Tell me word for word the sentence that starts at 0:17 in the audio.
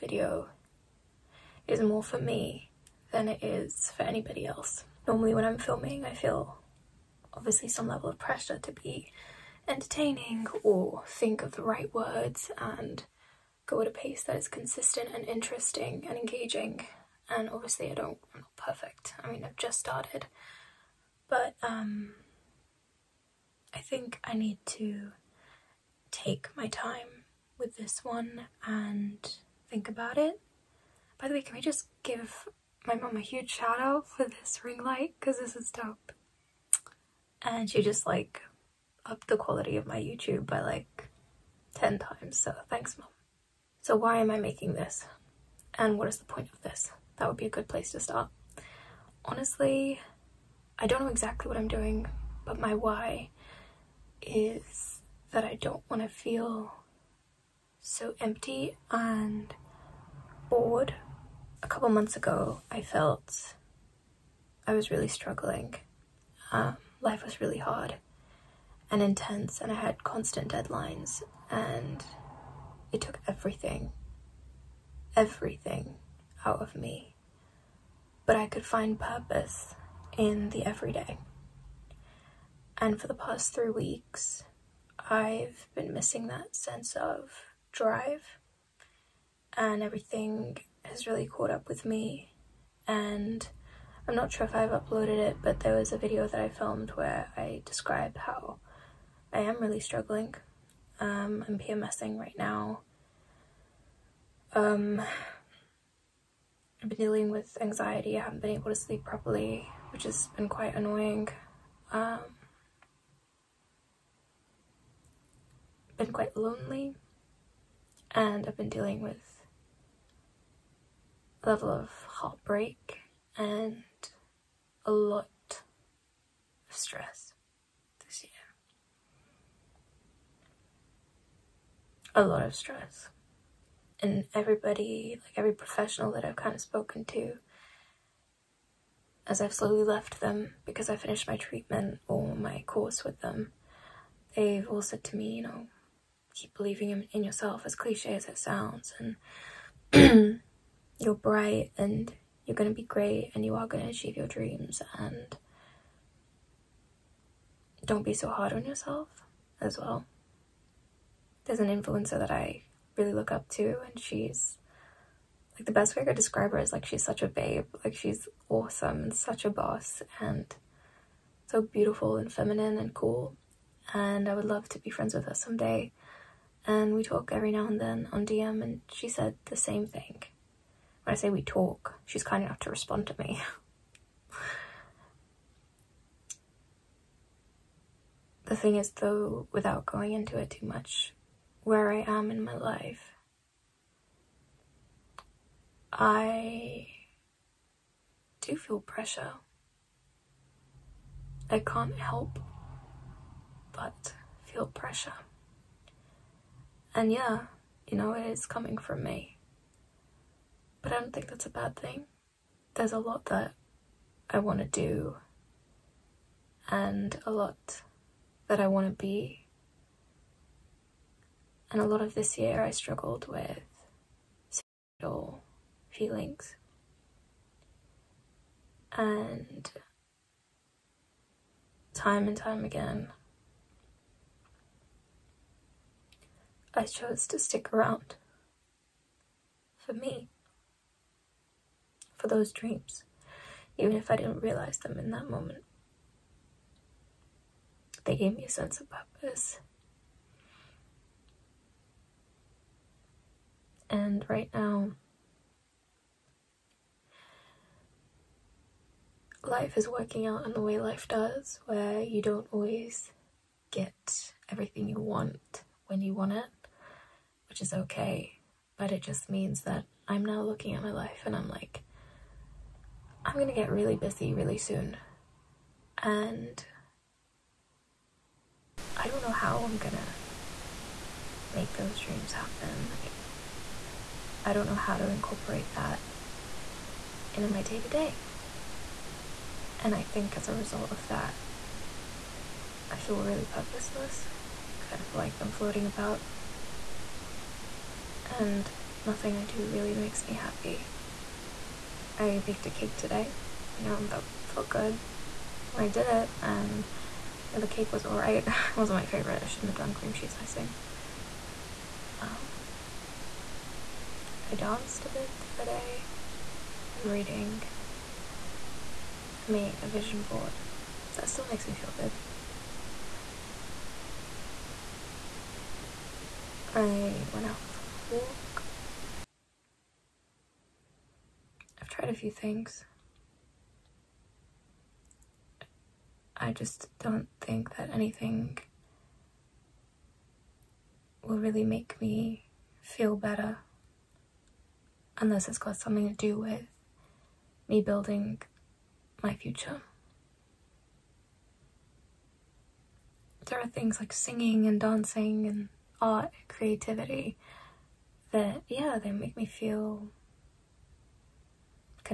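And obviously I don't, I'm not perfect.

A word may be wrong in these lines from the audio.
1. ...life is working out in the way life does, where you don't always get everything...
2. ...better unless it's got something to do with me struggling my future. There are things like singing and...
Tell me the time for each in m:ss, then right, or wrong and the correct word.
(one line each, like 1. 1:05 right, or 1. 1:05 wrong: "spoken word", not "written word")
1. 4:19 right
2. 5:43 wrong: "building", not "struggling".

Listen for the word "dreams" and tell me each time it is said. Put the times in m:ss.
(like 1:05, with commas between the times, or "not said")
2:34, 4:02, 4:41.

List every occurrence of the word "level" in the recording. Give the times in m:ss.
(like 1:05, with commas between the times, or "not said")
0:07, 2:01.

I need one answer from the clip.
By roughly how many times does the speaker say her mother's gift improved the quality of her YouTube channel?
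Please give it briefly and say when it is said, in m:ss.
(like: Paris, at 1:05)
10 times, at 0:41.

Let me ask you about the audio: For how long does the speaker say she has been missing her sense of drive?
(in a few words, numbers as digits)
Three weeks.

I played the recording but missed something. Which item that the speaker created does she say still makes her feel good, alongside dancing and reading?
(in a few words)
Vision board.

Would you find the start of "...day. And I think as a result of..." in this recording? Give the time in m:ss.
4:47.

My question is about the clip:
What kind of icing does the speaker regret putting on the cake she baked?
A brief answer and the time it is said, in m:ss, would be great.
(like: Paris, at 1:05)
Cream cheese icing, at 5:09.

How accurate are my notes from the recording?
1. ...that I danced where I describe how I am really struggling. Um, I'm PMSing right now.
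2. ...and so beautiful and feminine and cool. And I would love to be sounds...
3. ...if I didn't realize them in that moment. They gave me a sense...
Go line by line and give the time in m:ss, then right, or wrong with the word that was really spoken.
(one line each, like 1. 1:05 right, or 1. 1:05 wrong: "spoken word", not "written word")
1. 1:36 wrong: "filmed", not "danced"
2. 2:50 wrong: "friends", not "sounds"
3. 4:03 right.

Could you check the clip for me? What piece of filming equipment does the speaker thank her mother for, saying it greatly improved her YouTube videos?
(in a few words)
Ring light.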